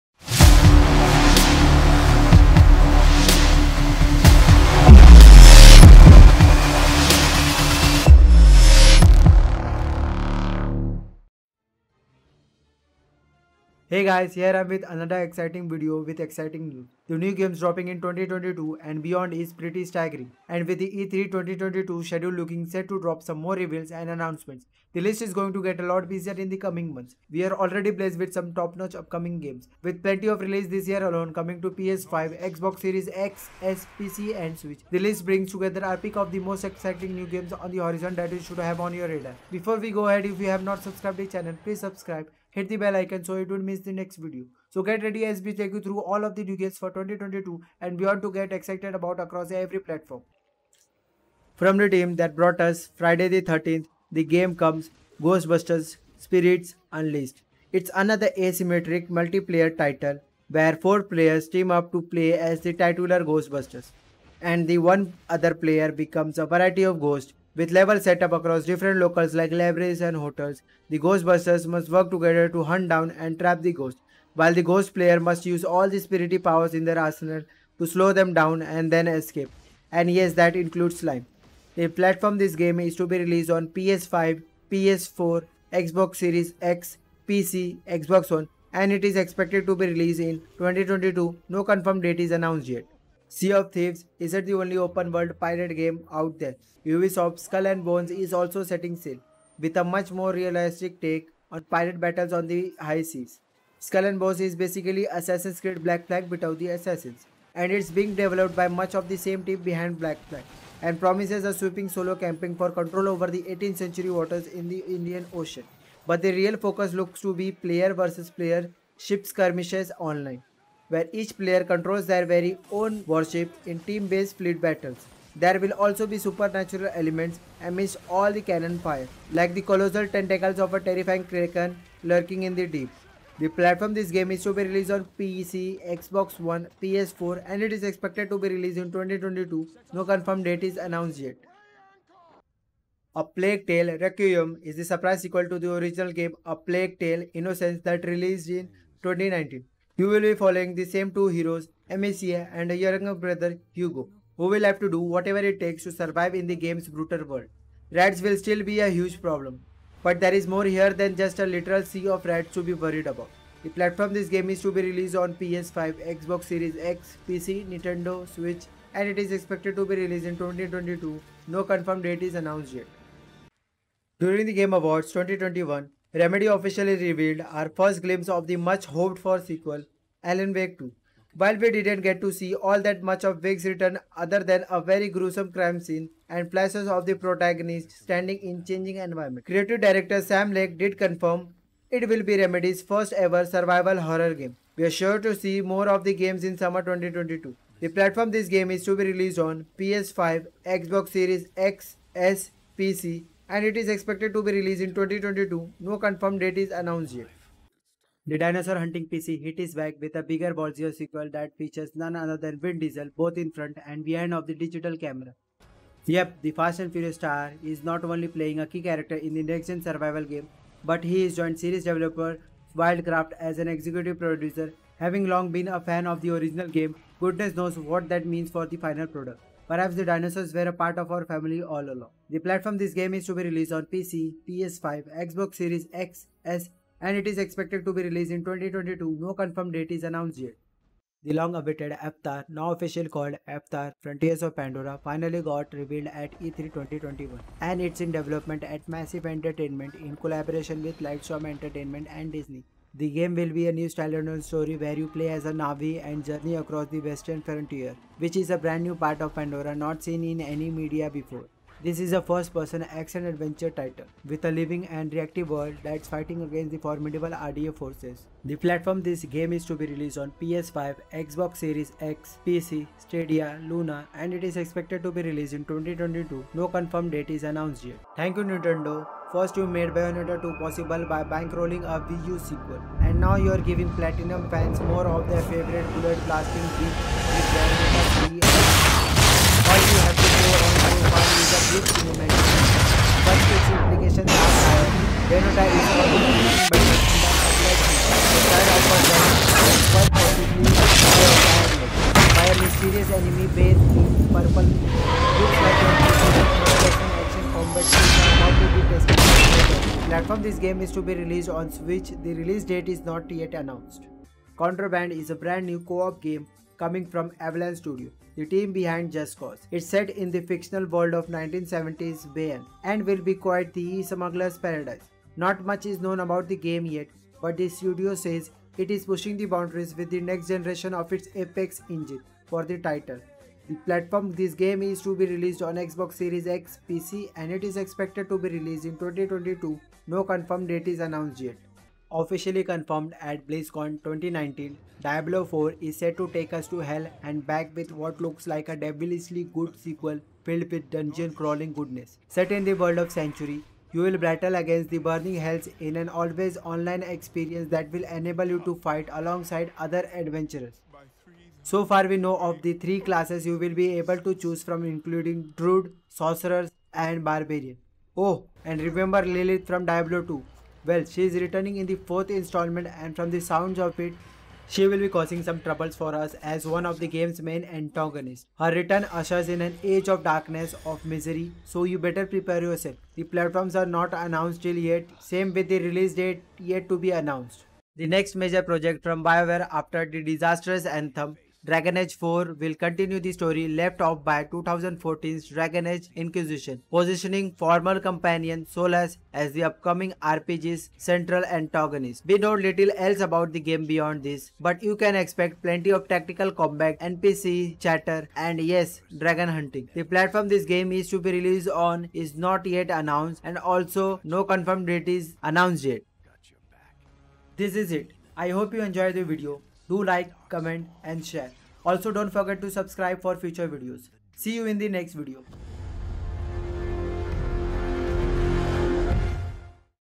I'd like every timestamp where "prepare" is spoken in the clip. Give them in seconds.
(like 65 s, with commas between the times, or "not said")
382 s.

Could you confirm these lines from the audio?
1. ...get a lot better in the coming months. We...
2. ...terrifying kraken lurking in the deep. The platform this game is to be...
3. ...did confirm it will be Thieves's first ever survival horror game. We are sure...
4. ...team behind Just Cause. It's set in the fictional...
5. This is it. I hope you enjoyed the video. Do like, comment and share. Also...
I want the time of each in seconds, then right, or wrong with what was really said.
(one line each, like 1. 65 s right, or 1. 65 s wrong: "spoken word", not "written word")
1. 25 s wrong: "busier", not "better"
2. 130 s right
3. 190 s wrong: "Remedy", not "Thieves"
4. 318 s right
5. 417 s right.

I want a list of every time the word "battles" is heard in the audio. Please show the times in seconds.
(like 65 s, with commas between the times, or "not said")
102 s, 124 s, 354 s.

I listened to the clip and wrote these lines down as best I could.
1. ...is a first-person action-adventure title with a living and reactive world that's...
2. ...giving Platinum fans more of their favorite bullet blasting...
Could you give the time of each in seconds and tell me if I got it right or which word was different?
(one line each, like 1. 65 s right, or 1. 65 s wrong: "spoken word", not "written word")
1. 261 s right
2. 283 s right.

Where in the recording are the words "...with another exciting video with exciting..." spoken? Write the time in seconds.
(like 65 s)
14 s.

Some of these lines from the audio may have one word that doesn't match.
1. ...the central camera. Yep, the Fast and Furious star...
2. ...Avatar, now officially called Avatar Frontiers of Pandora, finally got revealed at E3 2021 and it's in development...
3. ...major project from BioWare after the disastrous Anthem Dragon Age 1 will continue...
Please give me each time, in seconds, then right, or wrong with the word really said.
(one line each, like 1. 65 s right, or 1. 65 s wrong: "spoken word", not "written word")
1. 214 s wrong: "digital", not "central"
2. 241 s right
3. 388 s wrong: "4", not "1".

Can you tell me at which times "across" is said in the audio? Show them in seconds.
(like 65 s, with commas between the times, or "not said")
49 s, 68 s, 256 s.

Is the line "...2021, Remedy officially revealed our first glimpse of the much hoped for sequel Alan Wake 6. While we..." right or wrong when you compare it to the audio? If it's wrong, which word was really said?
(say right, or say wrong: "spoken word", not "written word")
wrong: "2", not "6".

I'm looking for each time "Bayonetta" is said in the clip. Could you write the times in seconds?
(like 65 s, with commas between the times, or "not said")
279 s, 287 s.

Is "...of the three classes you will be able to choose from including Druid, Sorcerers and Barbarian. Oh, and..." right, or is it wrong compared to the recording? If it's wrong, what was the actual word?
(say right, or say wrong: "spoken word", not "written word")
right.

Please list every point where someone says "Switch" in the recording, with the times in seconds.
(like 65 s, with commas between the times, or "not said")
34 s, 168 s, 311 s.